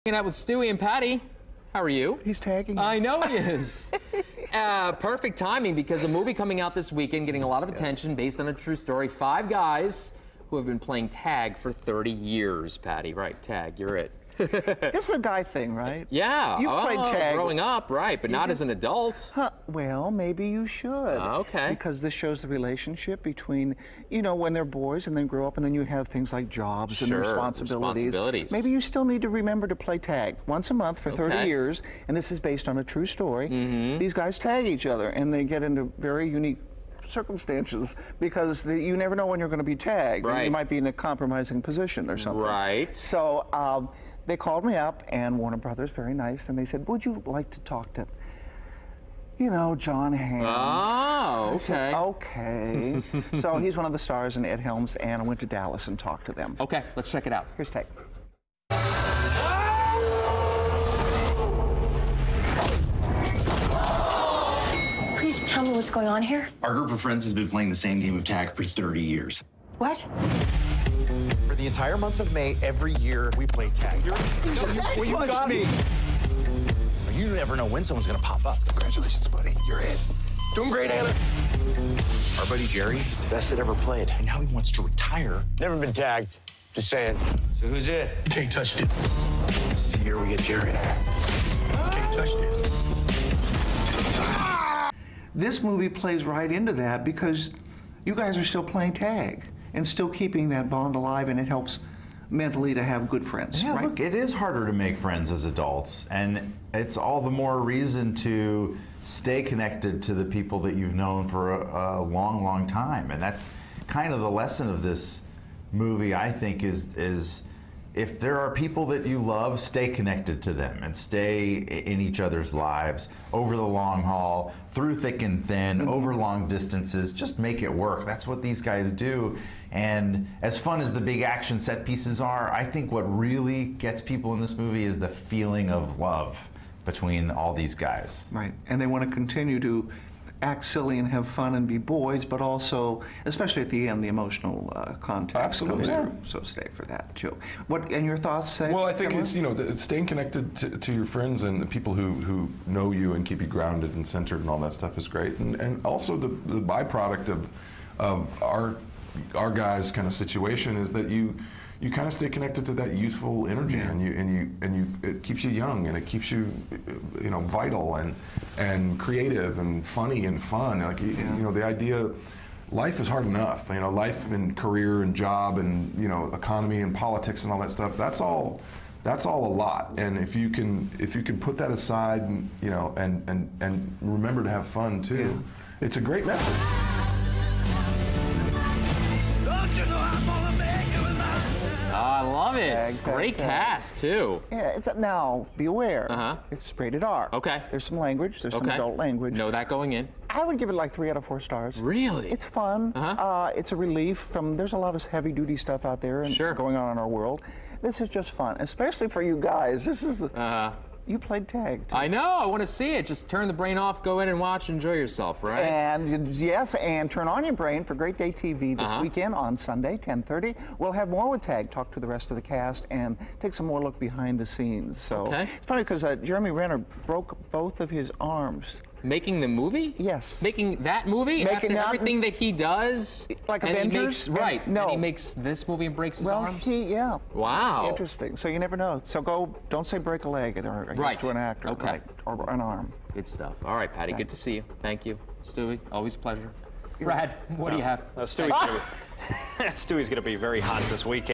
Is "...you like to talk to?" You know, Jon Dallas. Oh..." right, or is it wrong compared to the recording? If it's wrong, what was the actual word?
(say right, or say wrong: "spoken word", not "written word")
wrong: "Hamm", not "Dallas".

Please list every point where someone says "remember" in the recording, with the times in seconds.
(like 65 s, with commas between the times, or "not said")
29 s, 184 s.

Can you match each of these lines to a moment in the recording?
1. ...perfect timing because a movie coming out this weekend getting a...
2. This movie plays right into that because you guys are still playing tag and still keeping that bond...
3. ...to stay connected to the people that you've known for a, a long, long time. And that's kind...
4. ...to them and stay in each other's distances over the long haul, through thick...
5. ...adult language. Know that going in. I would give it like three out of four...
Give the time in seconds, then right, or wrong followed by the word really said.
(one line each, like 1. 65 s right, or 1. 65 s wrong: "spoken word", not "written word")
1. 4 s right
2. 95 s right
3. 108 s right
4. 120 s wrong: "lives", not "distances"
5. 198 s right.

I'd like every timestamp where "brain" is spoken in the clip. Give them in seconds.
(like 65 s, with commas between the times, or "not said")
213 s, 217 s.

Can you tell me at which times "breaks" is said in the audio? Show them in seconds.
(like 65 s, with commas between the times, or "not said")
235 s, 239 s.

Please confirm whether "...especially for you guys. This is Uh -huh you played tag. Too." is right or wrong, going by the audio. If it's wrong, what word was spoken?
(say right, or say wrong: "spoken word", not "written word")
right.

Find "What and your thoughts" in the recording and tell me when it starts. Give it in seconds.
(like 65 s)
147 s.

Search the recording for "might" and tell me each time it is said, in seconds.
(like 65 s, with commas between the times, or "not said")
40 s.